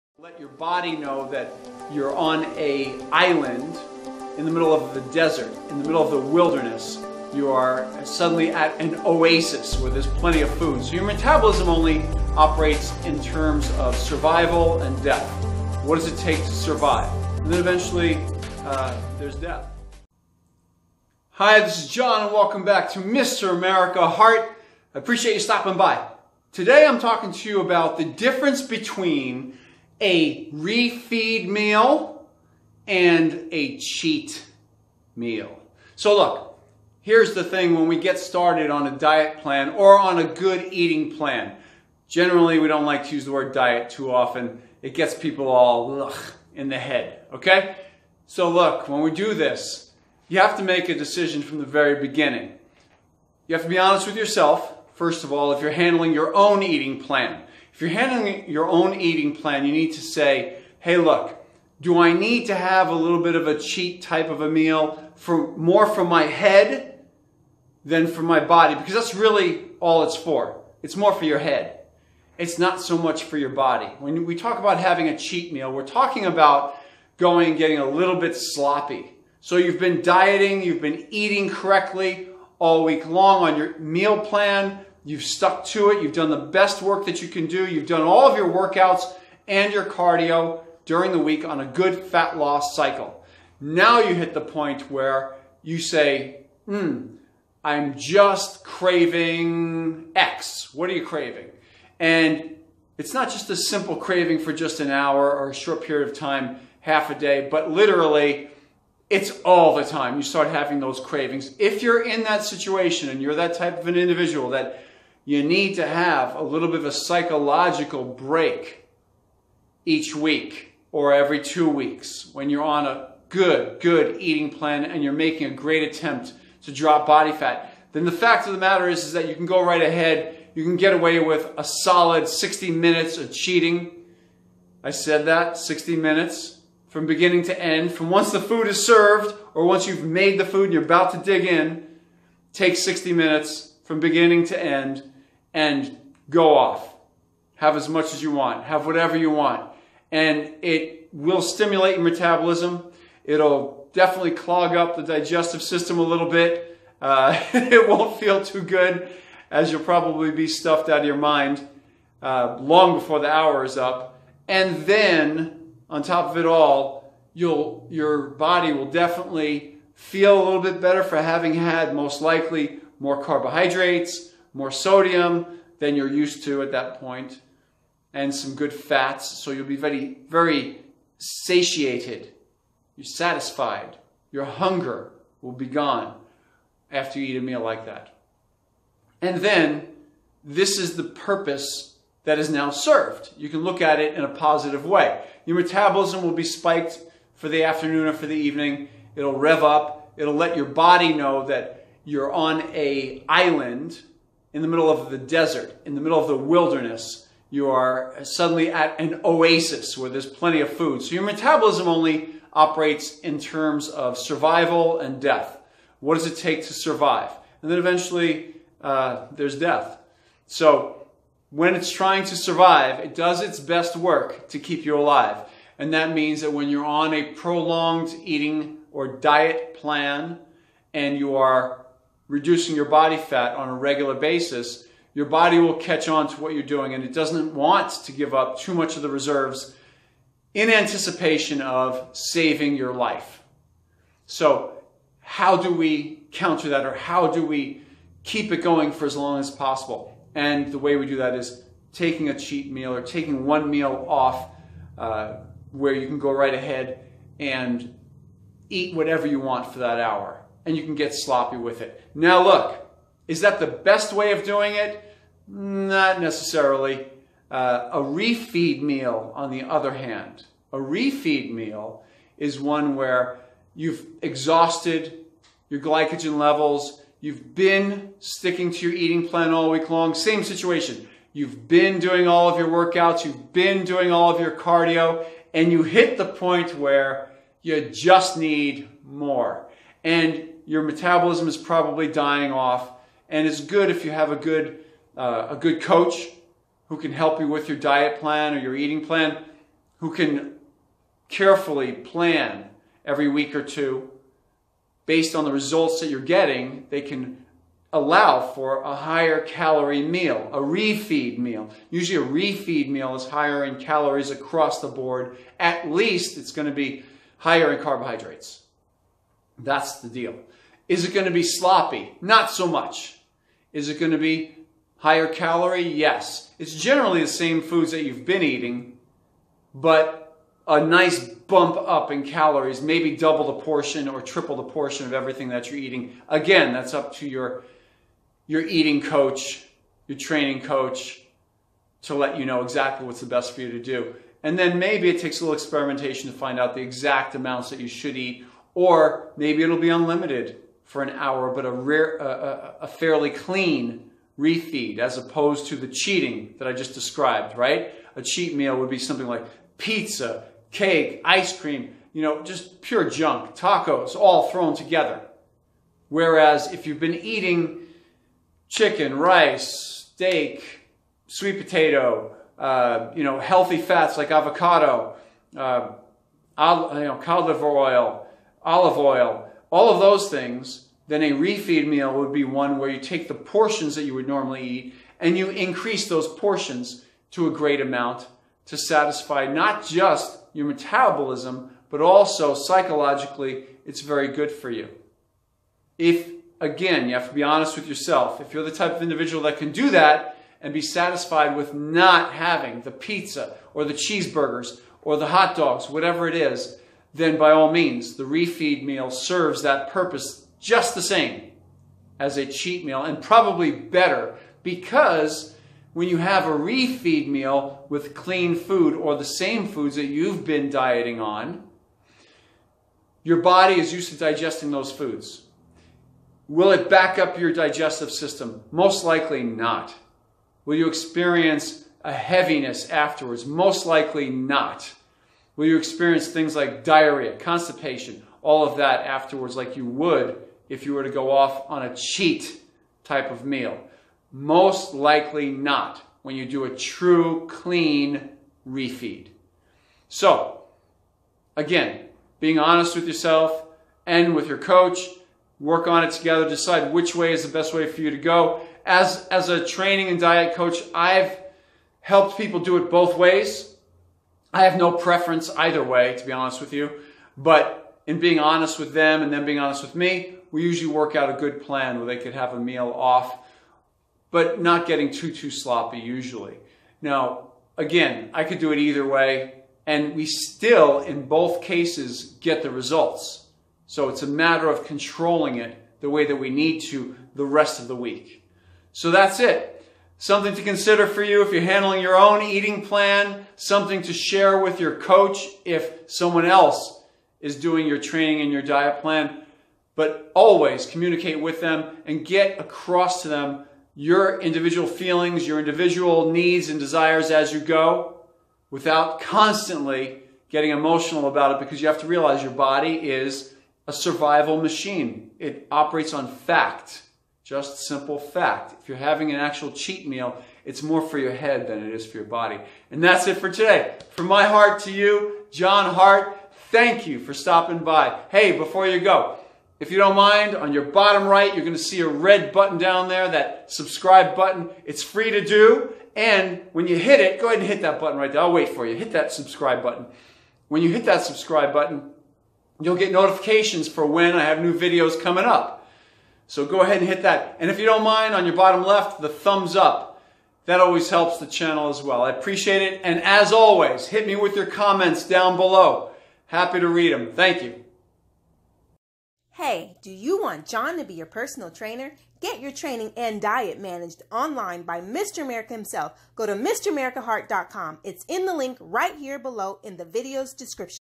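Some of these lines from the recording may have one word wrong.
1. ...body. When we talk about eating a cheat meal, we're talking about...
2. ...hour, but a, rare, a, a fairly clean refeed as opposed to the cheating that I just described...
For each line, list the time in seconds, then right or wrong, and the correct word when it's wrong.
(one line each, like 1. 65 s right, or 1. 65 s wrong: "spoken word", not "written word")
1. 73 s wrong: "having", not "eating"
2. 351 s right.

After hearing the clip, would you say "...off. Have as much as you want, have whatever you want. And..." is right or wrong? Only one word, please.
right.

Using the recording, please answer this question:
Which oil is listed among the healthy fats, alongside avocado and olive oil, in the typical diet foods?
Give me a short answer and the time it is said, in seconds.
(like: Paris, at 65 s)
Cod liver oil, at 377 s.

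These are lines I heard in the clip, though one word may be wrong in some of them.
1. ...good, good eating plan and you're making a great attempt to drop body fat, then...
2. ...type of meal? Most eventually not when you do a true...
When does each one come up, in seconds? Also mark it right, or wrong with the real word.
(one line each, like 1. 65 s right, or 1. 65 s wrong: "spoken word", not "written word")
1. 123 s right
2. 443 s wrong: "likely", not "eventually".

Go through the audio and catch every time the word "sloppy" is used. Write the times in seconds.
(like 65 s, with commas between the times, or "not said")
78 s, 261 s, 321 s, 475 s.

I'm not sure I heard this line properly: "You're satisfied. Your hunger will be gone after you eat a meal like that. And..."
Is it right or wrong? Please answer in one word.
right.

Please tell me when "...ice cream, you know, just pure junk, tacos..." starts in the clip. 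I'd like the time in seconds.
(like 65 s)
361 s.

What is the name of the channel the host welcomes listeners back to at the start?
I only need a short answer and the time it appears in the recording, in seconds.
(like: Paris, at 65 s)
Mr. America Heart, at 22 s.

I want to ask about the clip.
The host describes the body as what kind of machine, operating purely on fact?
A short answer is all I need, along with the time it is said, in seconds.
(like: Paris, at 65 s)
A survival machine, at 513 s.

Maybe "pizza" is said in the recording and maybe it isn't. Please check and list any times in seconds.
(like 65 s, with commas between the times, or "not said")
359 s, 402 s.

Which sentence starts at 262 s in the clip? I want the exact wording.
Now look, is that the best way of doing it?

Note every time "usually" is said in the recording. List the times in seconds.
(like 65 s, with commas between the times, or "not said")
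311 s, 470 s, 475 s.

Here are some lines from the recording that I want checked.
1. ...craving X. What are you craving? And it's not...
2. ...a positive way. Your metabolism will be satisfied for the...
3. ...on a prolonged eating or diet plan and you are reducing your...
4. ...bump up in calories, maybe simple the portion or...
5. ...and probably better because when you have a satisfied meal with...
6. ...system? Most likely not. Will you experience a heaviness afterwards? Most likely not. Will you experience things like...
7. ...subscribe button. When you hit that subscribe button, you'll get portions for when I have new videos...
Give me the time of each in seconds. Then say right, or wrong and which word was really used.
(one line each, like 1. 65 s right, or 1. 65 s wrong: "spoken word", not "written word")
1. 98 s right
2. 194 s wrong: "spiked", not "satisfied"
3. 226 s right
4. 331 s wrong: "double", not "simple"
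5. 413 s wrong: "refeed", not "satisfied"
6. 428 s right
7. 539 s wrong: "notifications", not "portions".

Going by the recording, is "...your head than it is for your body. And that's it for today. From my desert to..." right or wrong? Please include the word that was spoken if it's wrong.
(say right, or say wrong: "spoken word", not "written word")
wrong: "heart", not "desert".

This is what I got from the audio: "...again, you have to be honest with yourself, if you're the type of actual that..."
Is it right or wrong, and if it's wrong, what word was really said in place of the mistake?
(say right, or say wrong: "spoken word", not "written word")
wrong: "individual", not "actual".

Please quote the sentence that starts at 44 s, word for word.
It gets people all ugh, in the head, okay?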